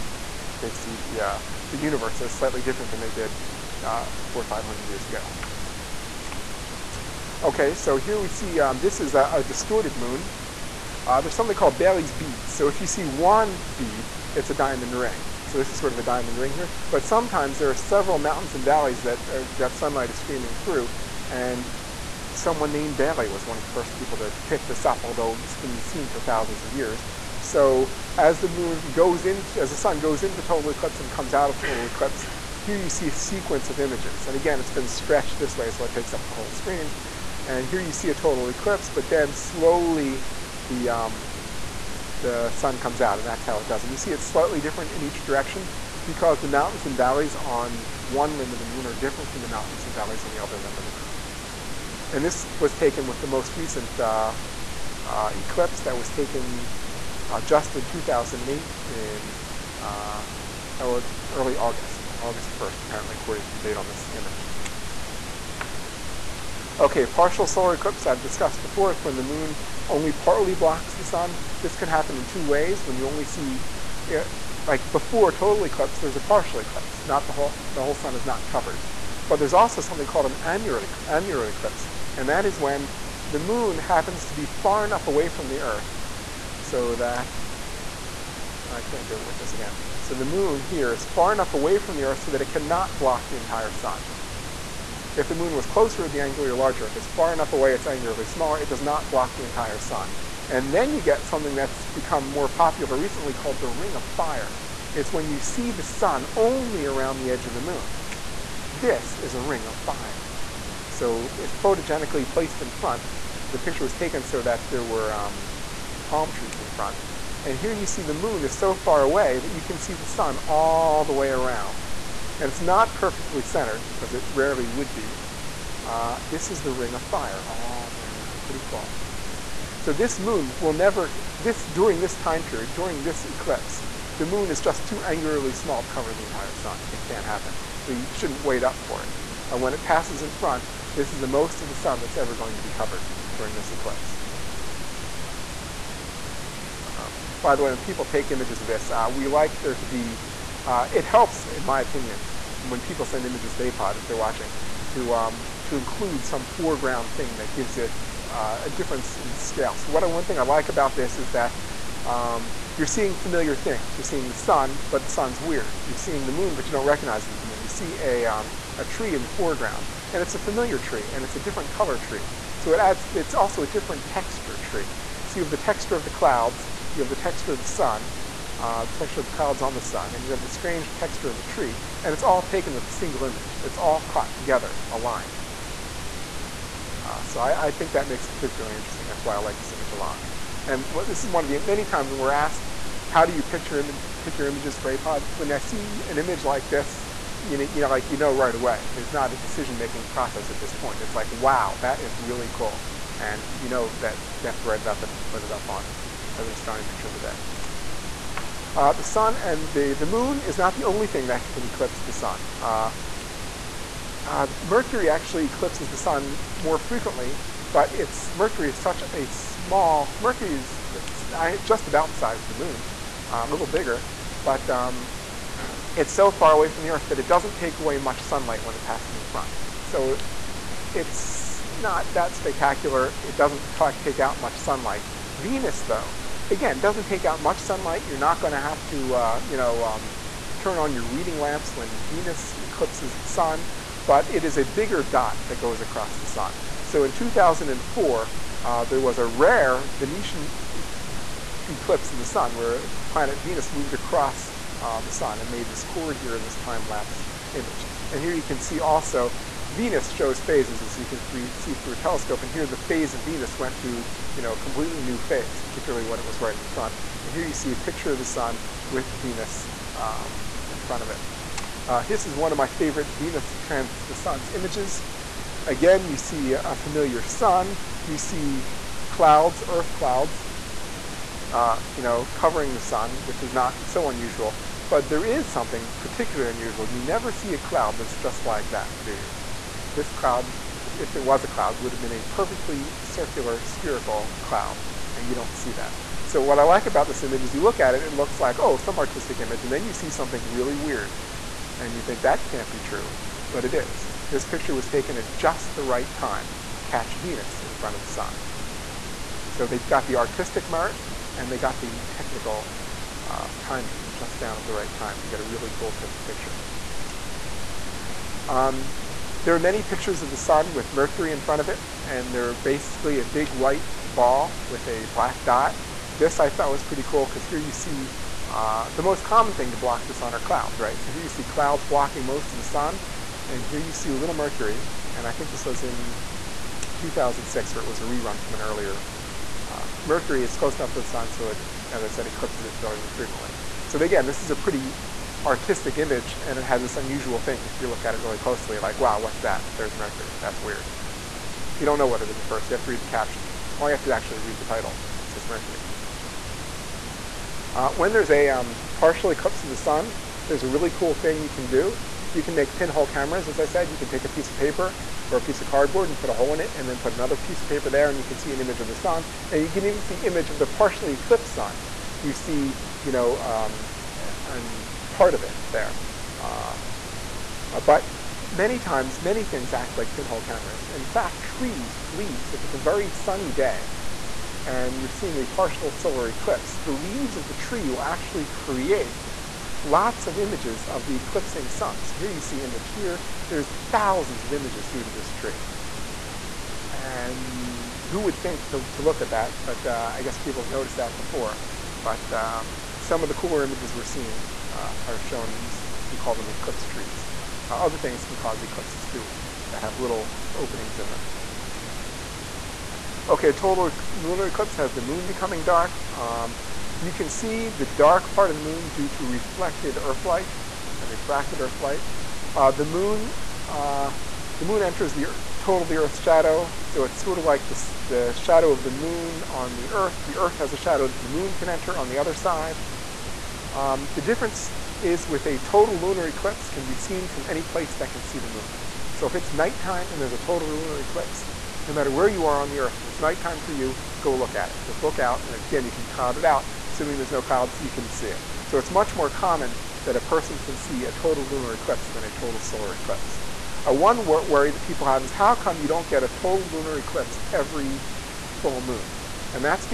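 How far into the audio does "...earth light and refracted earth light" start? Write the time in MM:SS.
06:59.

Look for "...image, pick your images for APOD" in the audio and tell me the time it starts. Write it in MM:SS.
03:13.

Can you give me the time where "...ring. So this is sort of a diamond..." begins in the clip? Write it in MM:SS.
00:14.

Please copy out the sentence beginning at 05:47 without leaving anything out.
If you look at it really closely, like, wow, what's that?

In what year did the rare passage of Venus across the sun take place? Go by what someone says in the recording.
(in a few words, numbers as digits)
2004.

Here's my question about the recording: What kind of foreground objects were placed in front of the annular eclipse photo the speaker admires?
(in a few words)
palm trees.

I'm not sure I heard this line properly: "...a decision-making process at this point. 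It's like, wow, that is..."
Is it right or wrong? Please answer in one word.
right.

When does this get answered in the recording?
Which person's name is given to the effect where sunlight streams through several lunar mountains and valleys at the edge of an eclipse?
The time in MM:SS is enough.
00:22.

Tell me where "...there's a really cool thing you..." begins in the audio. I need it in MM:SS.
06:00.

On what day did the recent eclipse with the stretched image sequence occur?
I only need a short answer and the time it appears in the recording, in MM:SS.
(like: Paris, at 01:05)
August 1st, at 01:02.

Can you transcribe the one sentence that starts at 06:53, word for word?
Okay, a total lunar eclipse has the moon becoming dark.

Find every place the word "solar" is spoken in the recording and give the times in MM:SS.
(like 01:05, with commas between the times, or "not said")
01:07, 06:25, 07:32.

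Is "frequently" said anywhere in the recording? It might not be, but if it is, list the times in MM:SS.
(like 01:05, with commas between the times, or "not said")
03:36, 05:43.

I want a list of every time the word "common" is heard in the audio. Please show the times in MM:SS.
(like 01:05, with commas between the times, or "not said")
05:29, 07:29.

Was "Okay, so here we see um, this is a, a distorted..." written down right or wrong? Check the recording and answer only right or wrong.
right.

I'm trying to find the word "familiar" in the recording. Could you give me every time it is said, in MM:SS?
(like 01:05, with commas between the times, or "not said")
02:43, 02:50, 04:36.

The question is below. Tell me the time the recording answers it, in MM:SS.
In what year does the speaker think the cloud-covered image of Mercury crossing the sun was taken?
05:36.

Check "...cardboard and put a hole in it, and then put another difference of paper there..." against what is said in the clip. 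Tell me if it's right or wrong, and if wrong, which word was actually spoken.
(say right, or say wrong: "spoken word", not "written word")
wrong: "piece", not "difference".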